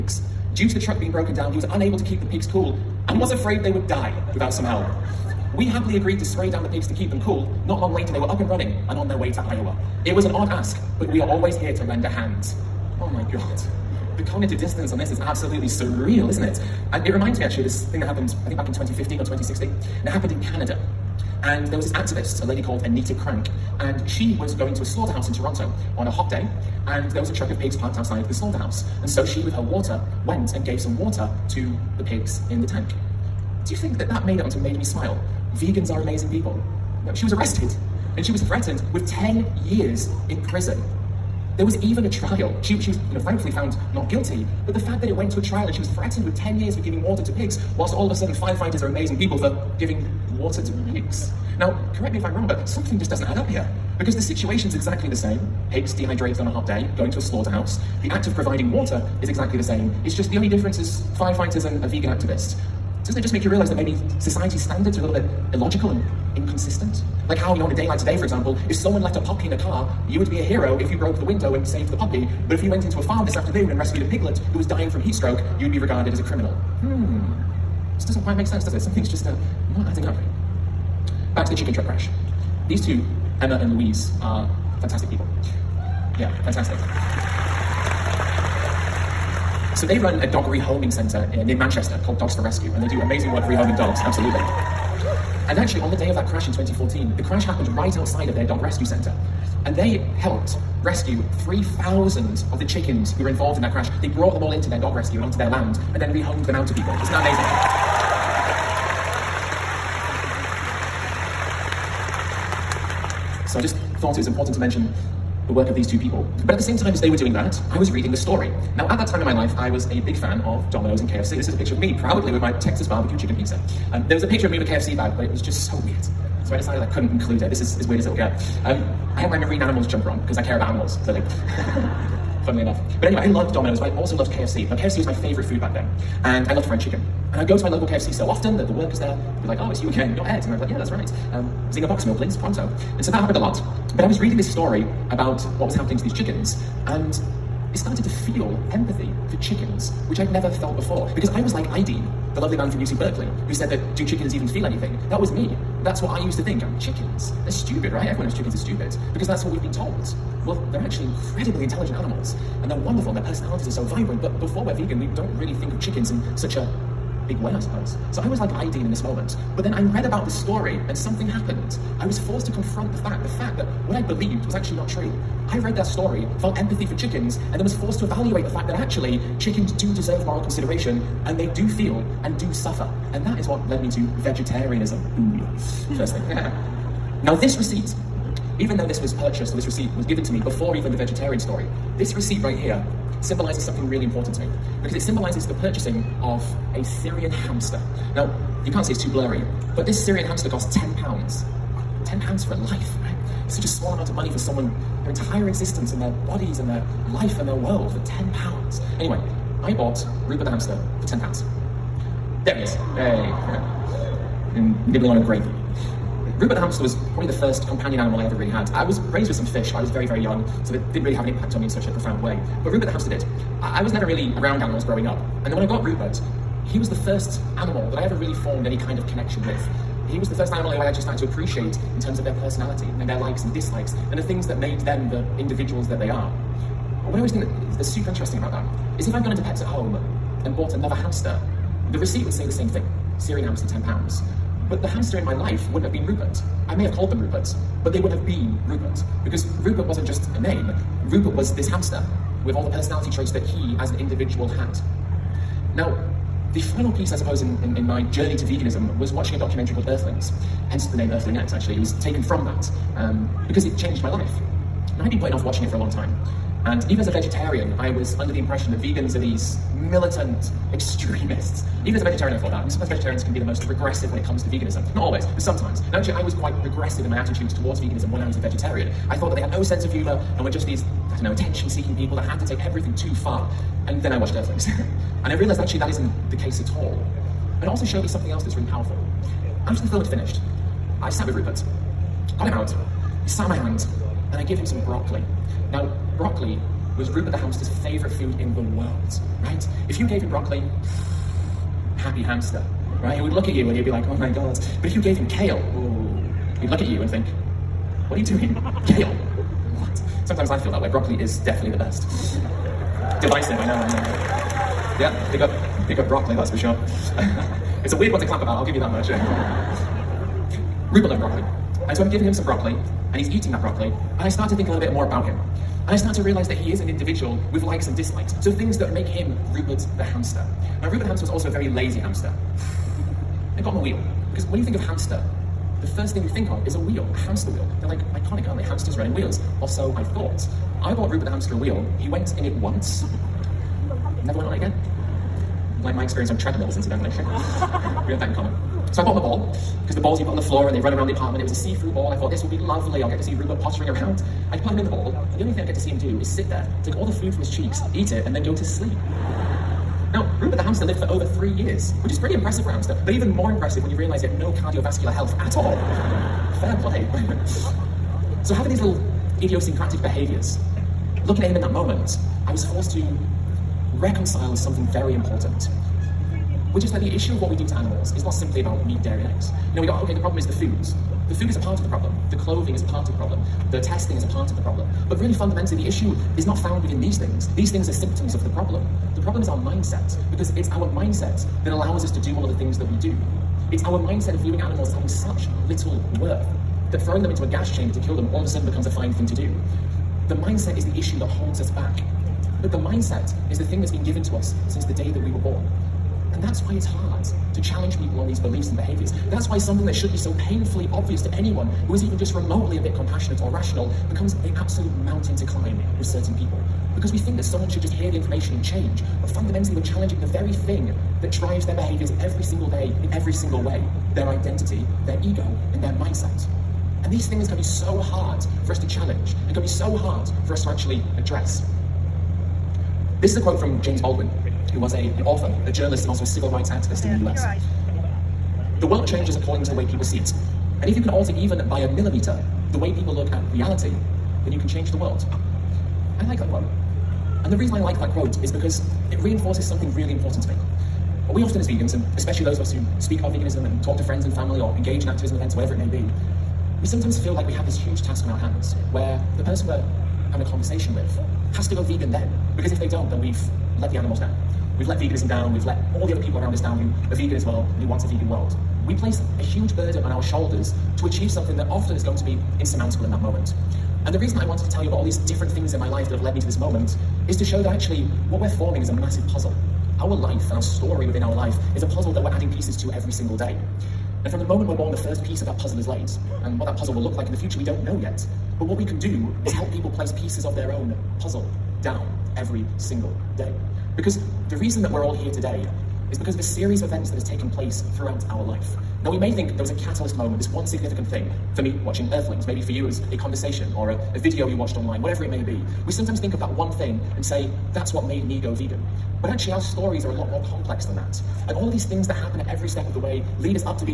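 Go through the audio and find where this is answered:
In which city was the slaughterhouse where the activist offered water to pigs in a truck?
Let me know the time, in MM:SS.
00:25.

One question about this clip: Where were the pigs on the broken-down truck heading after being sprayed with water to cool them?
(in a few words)
Iowa.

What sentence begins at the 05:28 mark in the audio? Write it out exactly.
So things that make him Rupert the hamster.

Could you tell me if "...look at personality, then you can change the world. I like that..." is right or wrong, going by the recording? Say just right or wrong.
wrong.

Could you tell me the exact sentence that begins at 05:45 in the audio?
Like my experience on treadmills, incidentally.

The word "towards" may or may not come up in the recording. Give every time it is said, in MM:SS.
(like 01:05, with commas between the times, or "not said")
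04:37.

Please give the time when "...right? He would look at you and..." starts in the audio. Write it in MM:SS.
05:03.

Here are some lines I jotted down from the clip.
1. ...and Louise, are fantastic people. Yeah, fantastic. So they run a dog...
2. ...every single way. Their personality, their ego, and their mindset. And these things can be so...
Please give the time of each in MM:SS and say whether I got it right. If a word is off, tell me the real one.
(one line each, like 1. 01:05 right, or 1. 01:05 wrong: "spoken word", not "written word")
1. 01:23 right
2. 07:03 wrong: "identity", not "personality".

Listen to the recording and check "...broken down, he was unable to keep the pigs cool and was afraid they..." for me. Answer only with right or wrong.
right.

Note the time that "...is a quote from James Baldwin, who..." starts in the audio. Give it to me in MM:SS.
07:13.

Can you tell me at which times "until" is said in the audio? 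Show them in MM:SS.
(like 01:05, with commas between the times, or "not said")
not said.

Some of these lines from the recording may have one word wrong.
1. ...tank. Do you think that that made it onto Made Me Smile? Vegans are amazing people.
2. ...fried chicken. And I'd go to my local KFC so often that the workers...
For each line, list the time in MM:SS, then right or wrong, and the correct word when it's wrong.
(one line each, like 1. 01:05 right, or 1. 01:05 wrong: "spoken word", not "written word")
1. 00:32 right
2. 02:16 right.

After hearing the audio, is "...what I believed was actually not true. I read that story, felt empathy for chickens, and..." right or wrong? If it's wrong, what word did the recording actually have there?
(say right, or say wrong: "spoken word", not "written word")
right.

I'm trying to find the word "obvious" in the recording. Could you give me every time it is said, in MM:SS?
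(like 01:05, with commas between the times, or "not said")
06:50.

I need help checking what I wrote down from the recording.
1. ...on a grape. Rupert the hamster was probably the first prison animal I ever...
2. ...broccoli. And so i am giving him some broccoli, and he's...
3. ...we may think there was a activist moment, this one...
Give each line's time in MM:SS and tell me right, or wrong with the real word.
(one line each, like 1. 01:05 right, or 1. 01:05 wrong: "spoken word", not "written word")
1. 03:35 wrong: "companion", not "prison"
2. 05:21 right
3. 08:19 wrong: "catalyst", not "activist".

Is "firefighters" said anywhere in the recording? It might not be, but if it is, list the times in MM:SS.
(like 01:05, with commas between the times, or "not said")
00:48, 01:01.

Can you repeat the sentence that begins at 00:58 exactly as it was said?
The act of providing water is exactly the same.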